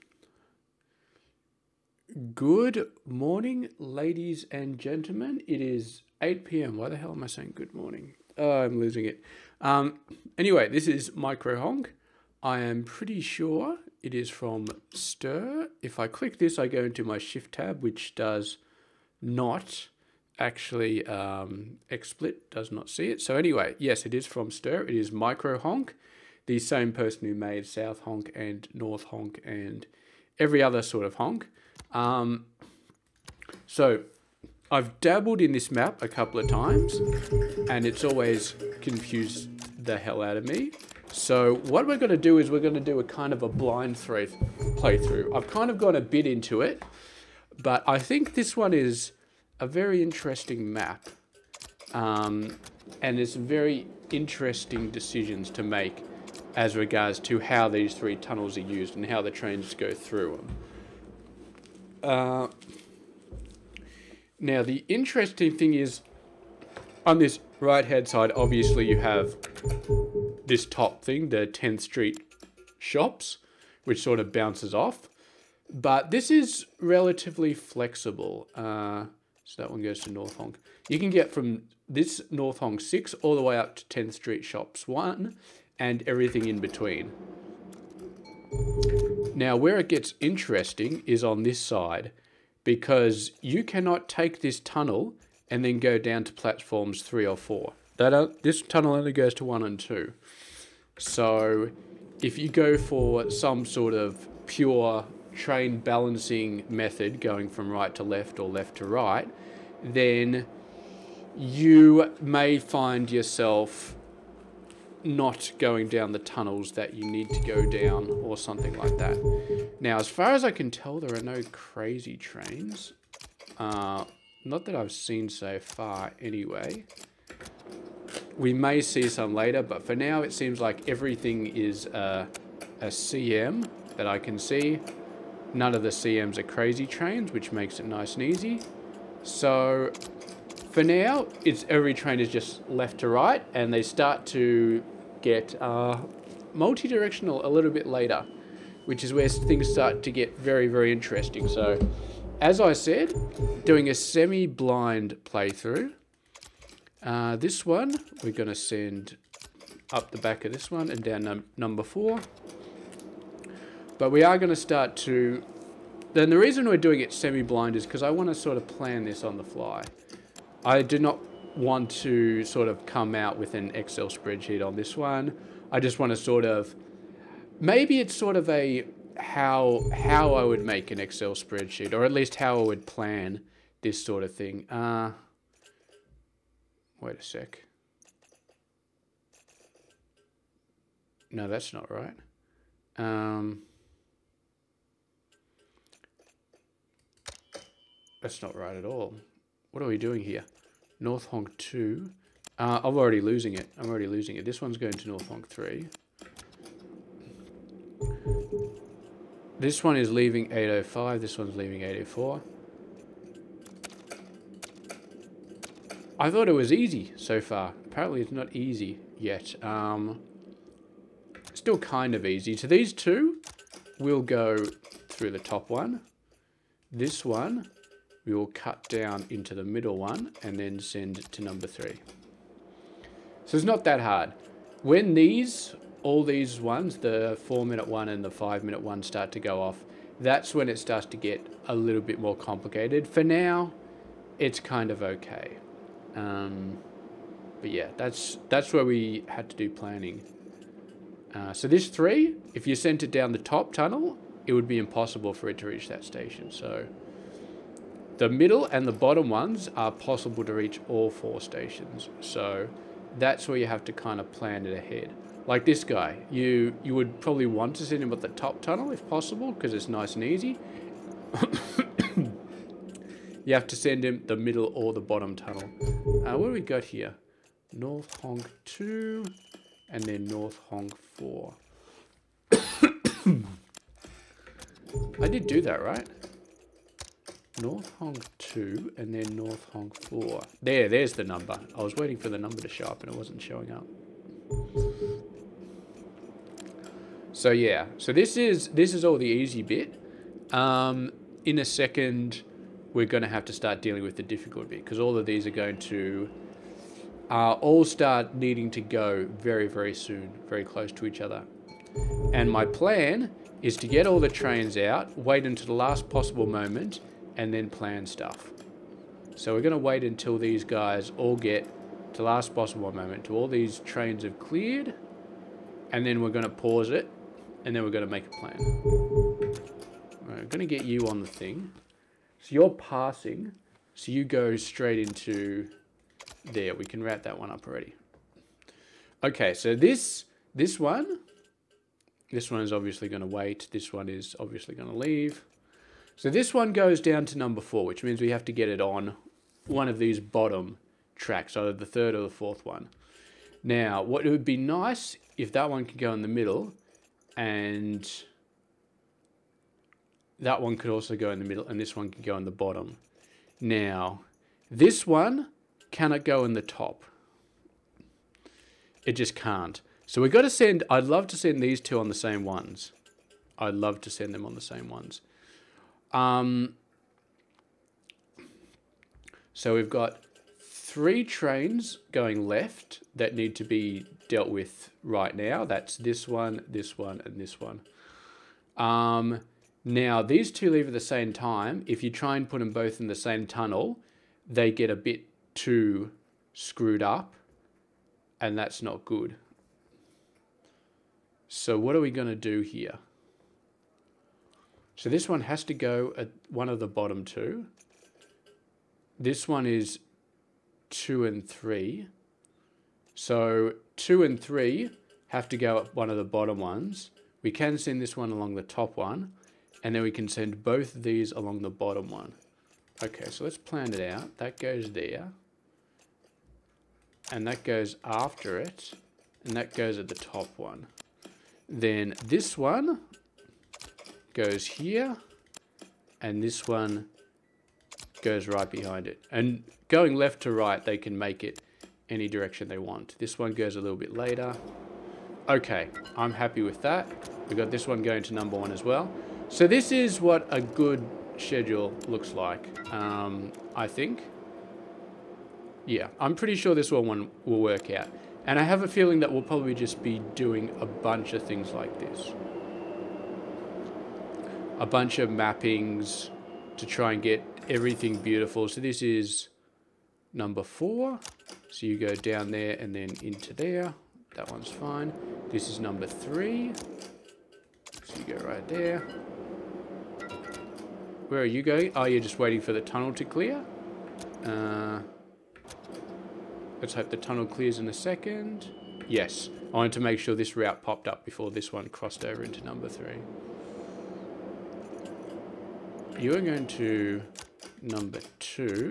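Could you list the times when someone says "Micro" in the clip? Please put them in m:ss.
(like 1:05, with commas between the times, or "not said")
0:11, 0:25.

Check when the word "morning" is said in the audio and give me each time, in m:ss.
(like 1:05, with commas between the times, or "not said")
0:03, 0:07.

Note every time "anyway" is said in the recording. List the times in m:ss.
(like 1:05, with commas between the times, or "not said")
0:10, 0:23, 2:06.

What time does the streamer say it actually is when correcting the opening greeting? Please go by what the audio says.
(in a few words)
8 p.m.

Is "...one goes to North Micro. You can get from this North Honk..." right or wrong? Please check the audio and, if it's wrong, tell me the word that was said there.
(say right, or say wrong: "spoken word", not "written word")
wrong: "Honk", not "Micro".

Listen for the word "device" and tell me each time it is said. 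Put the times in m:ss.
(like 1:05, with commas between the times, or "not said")
not said.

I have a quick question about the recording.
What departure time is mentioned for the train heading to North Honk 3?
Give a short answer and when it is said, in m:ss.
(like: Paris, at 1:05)
805, at 3:30.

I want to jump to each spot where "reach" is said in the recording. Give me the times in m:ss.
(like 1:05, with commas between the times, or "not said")
4:15, 4:20.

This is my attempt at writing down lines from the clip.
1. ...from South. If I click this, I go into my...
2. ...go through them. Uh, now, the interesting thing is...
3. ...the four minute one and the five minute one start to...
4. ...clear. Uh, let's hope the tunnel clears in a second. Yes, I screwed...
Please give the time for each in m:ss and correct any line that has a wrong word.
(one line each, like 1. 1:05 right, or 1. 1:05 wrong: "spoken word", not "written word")
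1. 0:14 wrong: "Stir", not "South"
2. 0:59 right
3. 3:56 right
4. 8:03 wrong: "wanted", not "screwed".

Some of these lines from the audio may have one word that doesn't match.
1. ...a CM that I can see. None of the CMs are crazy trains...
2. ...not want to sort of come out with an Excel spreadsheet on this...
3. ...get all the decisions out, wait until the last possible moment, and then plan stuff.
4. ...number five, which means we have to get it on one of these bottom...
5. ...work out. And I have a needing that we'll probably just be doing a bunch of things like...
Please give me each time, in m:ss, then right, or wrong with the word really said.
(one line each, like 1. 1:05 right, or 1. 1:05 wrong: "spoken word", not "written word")
1. 2:12 right
2. 2:50 right
3. 5:13 wrong: "trains", not "decisions"
4. 5:47 wrong: "four", not "five"
5. 7:37 wrong: "feeling", not "needing".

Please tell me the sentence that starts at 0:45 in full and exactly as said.
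I've kind of gone a bit into it, but I think this one is a very interesting map.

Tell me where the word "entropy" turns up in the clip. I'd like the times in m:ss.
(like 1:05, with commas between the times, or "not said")
not said.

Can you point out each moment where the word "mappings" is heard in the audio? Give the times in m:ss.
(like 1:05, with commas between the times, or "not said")
7:45.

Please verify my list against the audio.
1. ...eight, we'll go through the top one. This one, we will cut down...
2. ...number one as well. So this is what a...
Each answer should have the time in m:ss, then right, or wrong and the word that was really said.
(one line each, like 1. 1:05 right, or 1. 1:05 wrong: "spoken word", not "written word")
1. 3:42 wrong: "two", not "eight"
2. 7:28 right.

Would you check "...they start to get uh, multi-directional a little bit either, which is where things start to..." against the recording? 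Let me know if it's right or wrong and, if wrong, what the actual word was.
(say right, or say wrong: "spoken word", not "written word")
wrong: "later", not "either".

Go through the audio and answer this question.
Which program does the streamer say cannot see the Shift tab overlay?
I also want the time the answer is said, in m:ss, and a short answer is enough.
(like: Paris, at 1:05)
XSplit, at 0:21.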